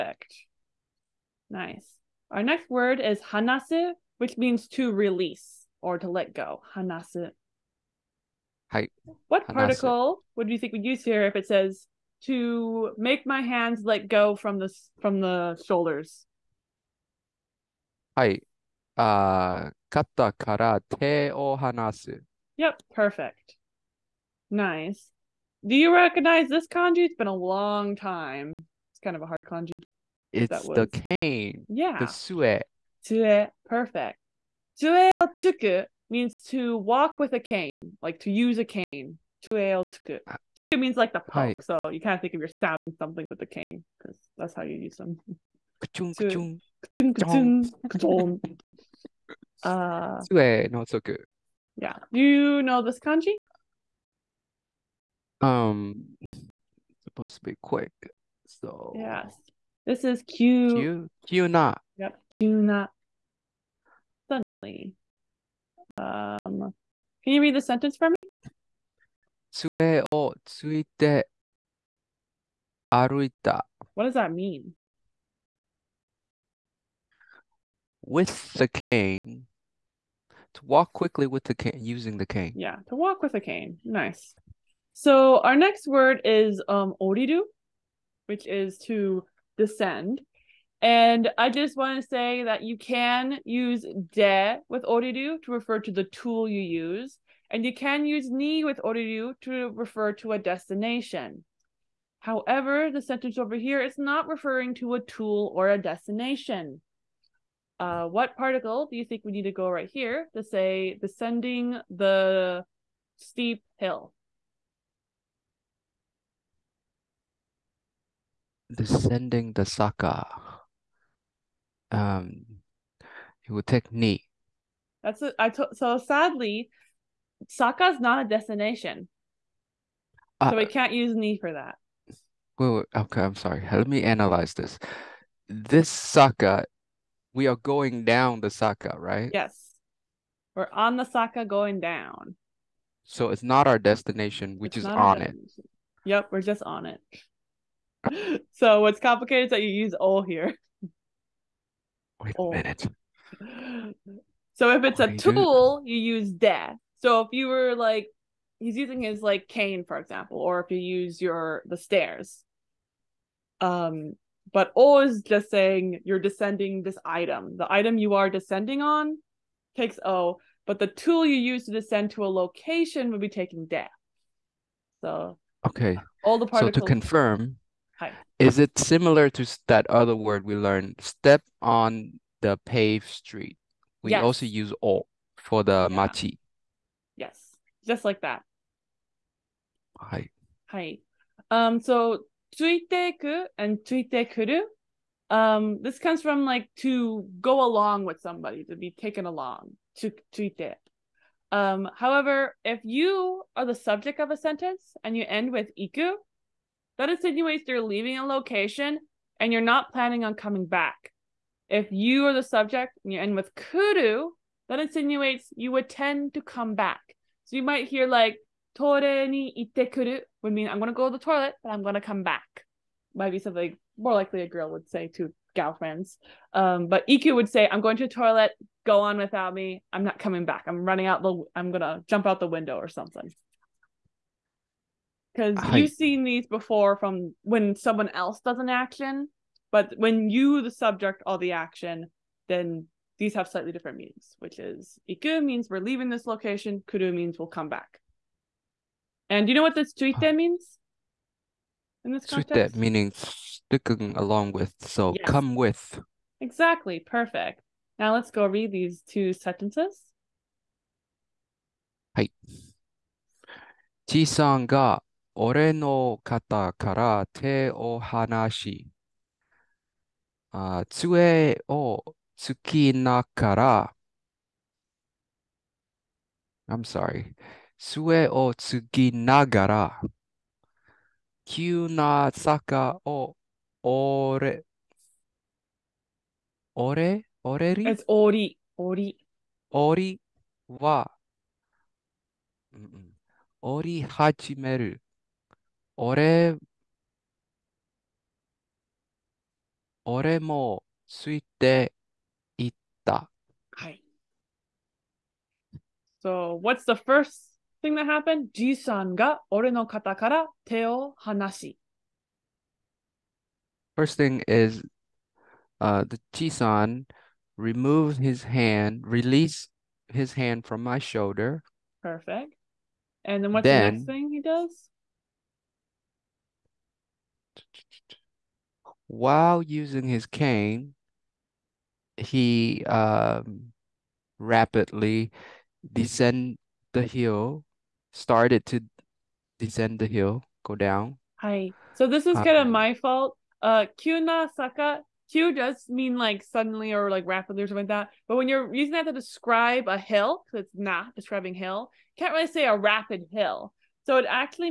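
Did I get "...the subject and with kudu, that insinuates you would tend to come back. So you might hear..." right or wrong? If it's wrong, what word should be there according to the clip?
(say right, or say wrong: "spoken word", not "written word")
right.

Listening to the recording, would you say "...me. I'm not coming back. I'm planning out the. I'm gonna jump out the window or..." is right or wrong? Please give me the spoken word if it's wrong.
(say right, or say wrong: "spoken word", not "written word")
wrong: "running", not "planning".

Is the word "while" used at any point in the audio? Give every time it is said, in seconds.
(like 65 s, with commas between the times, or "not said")
329 s.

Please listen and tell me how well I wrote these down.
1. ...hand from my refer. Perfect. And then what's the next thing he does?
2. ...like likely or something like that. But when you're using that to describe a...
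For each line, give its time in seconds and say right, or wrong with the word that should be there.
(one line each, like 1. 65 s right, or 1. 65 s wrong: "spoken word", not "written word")
1. 320 s wrong: "shoulder", not "refer"
2. 347 s wrong: "rapidly", not "likely".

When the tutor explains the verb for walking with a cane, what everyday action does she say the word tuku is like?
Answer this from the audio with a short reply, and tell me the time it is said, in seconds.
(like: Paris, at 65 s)
poke, at 41 s.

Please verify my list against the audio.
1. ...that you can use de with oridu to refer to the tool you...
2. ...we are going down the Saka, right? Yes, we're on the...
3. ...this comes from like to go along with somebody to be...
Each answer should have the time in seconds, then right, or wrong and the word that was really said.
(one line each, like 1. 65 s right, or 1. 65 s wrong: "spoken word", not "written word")
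1. 92 s right
2. 137 s right
3. 195 s right.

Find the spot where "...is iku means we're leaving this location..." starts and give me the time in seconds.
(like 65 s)
244 s.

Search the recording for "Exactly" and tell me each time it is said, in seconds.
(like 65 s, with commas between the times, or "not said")
256 s.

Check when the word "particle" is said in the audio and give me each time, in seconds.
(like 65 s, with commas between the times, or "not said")
9 s, 108 s, 176 s.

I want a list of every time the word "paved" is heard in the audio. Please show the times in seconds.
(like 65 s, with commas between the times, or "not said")
182 s.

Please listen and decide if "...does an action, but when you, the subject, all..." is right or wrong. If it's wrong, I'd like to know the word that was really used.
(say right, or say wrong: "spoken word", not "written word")
right.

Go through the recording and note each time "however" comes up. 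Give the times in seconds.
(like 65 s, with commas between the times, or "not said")
102 s, 201 s.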